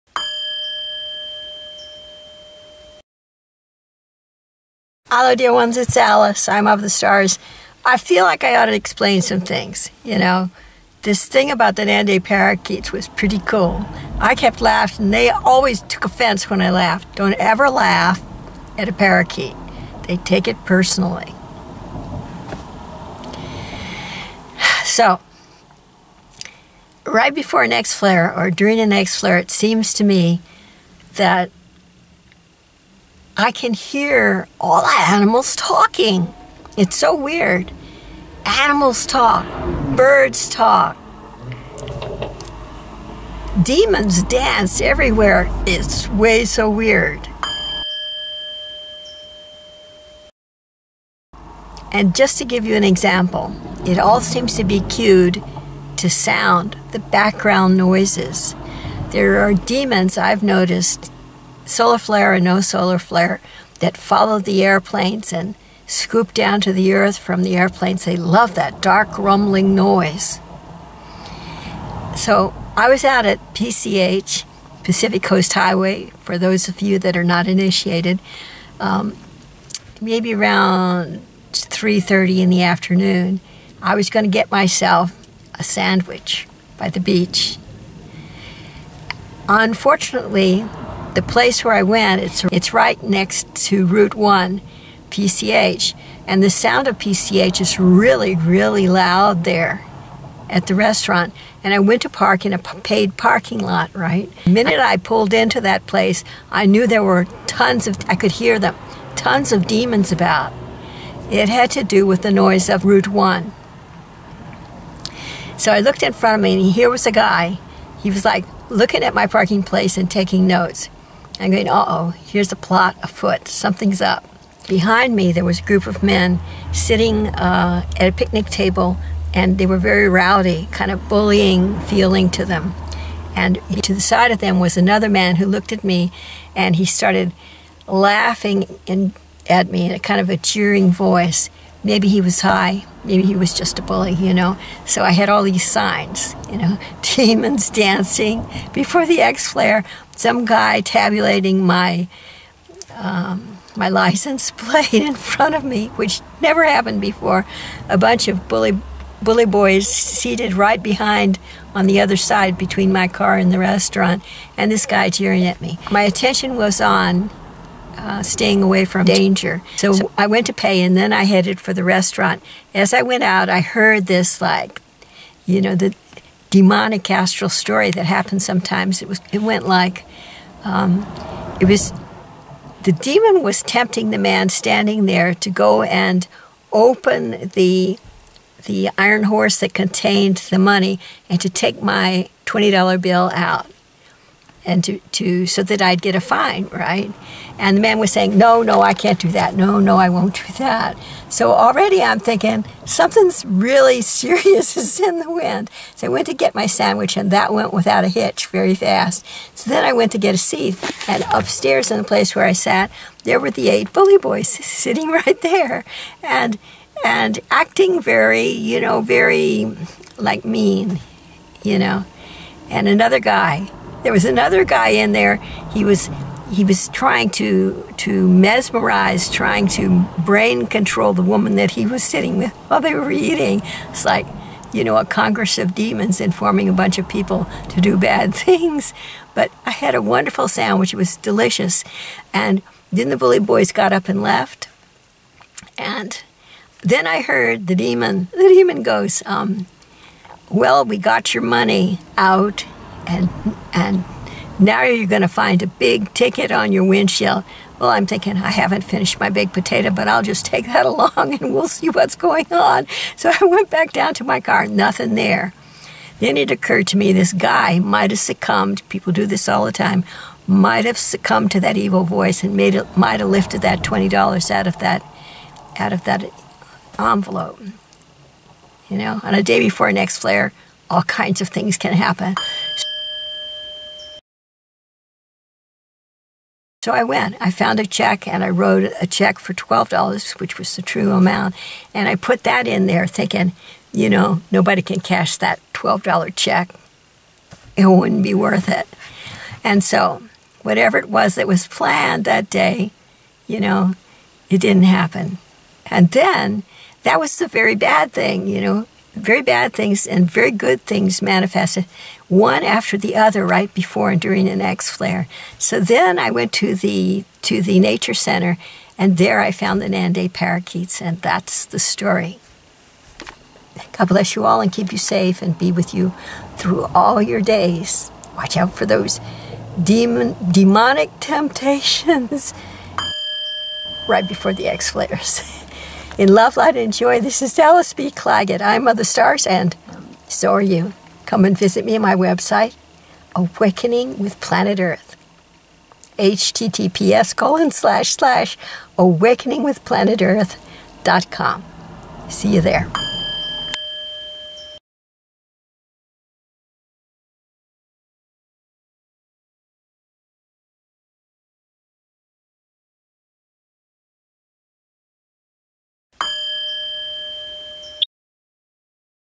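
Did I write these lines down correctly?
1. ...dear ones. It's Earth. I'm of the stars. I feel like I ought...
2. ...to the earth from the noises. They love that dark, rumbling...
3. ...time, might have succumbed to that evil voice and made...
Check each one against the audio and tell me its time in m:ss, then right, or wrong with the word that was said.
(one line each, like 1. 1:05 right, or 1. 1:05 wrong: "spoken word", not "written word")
1. 0:05 wrong: "Alice", not "Earth"
2. 1:06 wrong: "airplanes", not "noises"
3. 4:29 right.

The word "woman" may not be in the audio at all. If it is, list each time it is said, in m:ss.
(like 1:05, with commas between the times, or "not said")
3:51.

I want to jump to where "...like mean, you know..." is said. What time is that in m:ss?
3:40.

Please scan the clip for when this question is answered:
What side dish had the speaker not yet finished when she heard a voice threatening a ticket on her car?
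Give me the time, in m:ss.
4:19.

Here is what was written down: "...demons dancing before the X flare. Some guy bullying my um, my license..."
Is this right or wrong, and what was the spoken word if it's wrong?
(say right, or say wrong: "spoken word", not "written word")
wrong: "tabulating", not "bullying".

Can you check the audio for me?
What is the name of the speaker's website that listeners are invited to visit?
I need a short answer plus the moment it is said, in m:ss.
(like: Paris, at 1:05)
Awakening with Planet Earth, at 5:43.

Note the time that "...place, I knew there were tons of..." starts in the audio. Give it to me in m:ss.
1:45.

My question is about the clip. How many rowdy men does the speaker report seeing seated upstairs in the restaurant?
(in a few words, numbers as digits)
8.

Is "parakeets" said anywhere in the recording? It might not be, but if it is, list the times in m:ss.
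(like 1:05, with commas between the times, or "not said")
0:12, 0:18, 5:20.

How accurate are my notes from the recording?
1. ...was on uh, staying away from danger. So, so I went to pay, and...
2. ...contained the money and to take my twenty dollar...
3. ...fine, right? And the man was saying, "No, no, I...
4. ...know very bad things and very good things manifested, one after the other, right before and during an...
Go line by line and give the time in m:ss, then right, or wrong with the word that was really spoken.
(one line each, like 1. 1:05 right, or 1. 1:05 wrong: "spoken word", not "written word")
1. 2:46 right
2. 3:09 right
3. 3:16 right
4. 5:08 right.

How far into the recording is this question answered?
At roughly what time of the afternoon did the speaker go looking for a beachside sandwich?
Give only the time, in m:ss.
1:21.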